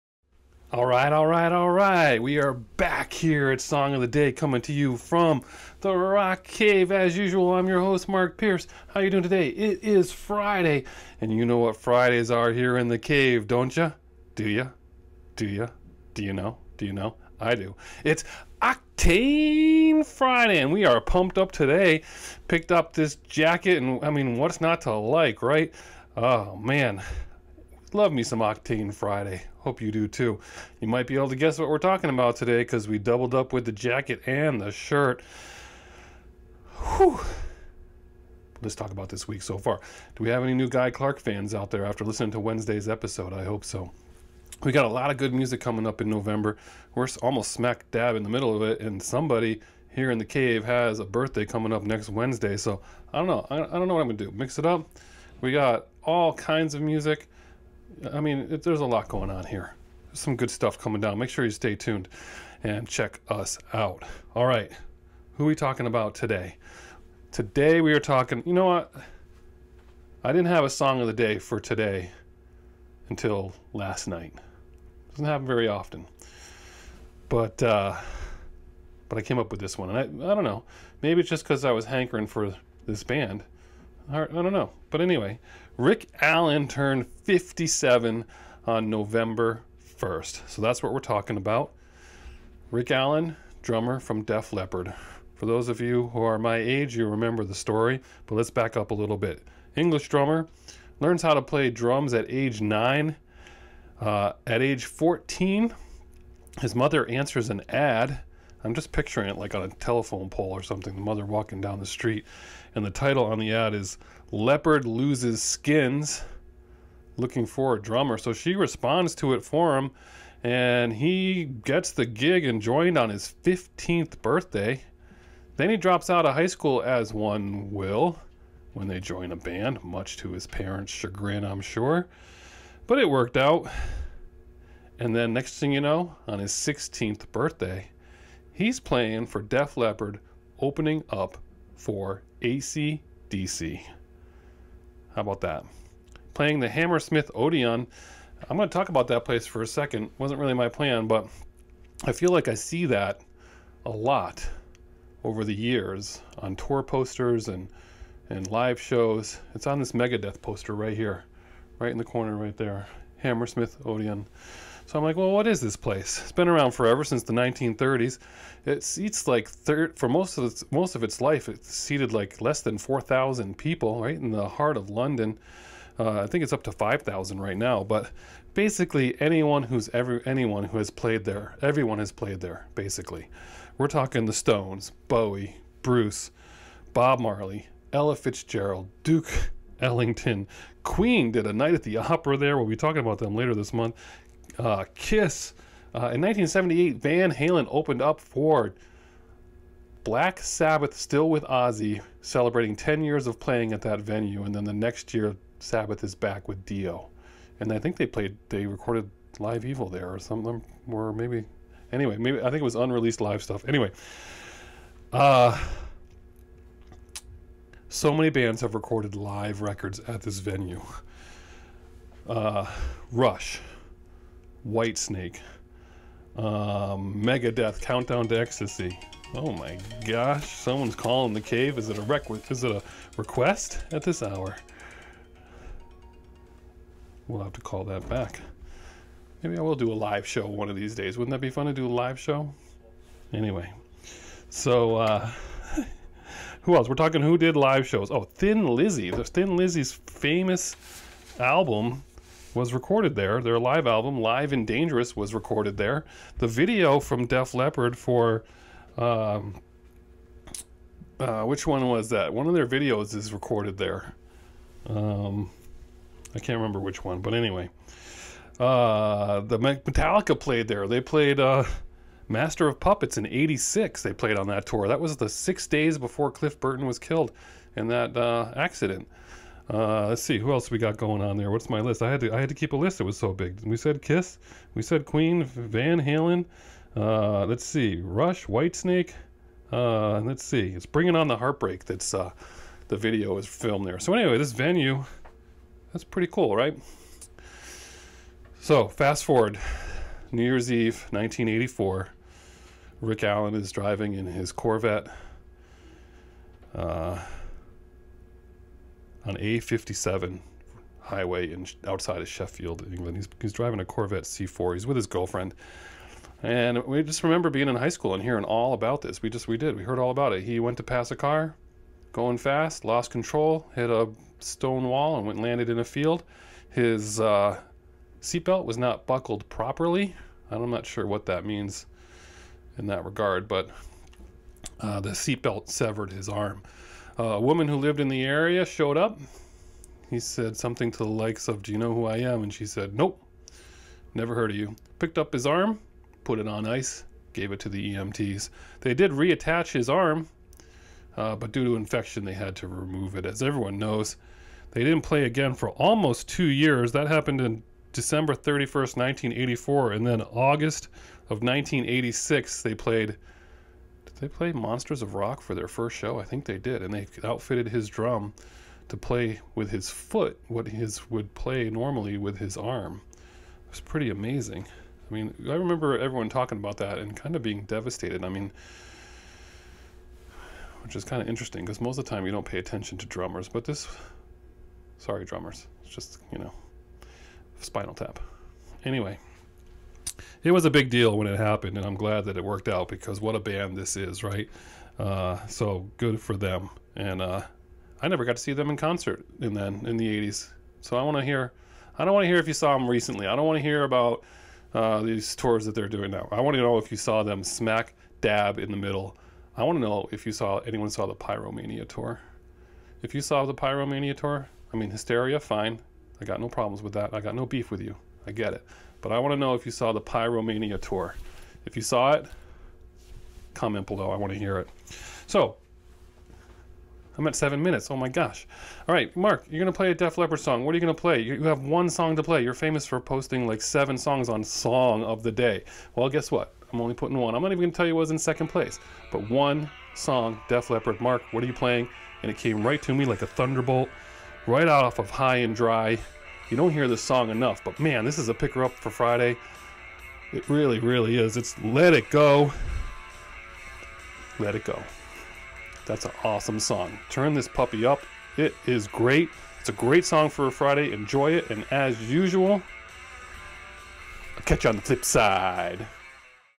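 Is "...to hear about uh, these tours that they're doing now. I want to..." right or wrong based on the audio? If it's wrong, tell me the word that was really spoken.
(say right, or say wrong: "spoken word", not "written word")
right.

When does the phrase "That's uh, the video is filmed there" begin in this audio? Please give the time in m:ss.
4:51.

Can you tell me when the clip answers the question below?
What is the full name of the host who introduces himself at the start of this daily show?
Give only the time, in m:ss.
0:08.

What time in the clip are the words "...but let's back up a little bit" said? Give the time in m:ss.
1:38.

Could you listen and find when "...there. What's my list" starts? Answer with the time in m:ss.
4:41.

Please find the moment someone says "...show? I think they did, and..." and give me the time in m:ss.
6:05.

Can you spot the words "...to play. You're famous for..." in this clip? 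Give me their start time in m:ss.
7:12.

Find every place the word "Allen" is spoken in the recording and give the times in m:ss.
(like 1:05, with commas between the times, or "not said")
1:26, 1:32, 5:03.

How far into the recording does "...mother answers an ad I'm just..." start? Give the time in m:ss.
1:46.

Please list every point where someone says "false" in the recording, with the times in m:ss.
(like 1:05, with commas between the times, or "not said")
not said.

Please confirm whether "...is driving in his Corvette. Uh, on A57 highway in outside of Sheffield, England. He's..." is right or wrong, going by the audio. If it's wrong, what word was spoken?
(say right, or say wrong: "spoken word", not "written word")
right.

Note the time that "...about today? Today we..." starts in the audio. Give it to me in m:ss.
1:05.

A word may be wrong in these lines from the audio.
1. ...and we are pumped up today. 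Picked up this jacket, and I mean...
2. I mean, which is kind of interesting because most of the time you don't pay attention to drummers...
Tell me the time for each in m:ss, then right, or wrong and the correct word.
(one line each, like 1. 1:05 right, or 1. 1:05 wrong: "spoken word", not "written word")
1. 0:20 right
2. 6:18 right.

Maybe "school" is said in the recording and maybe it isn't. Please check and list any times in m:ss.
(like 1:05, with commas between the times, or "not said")
2:06, 5:17.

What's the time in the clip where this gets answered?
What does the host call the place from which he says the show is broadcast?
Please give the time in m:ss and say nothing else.
0:05.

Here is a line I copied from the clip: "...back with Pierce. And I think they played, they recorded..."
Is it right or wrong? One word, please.
wrong.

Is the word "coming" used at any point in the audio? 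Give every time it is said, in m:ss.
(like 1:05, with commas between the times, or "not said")
0:04, 0:45, 0:51, 1:00.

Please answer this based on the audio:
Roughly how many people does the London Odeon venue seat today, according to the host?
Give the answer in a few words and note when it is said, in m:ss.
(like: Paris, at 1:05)
5,000, at 2:56.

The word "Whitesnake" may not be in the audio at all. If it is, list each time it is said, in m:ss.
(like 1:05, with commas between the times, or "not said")
3:44, 4:48.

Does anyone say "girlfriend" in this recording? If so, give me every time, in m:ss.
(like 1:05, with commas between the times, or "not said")
5:15.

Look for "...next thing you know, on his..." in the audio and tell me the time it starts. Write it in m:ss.
2:15.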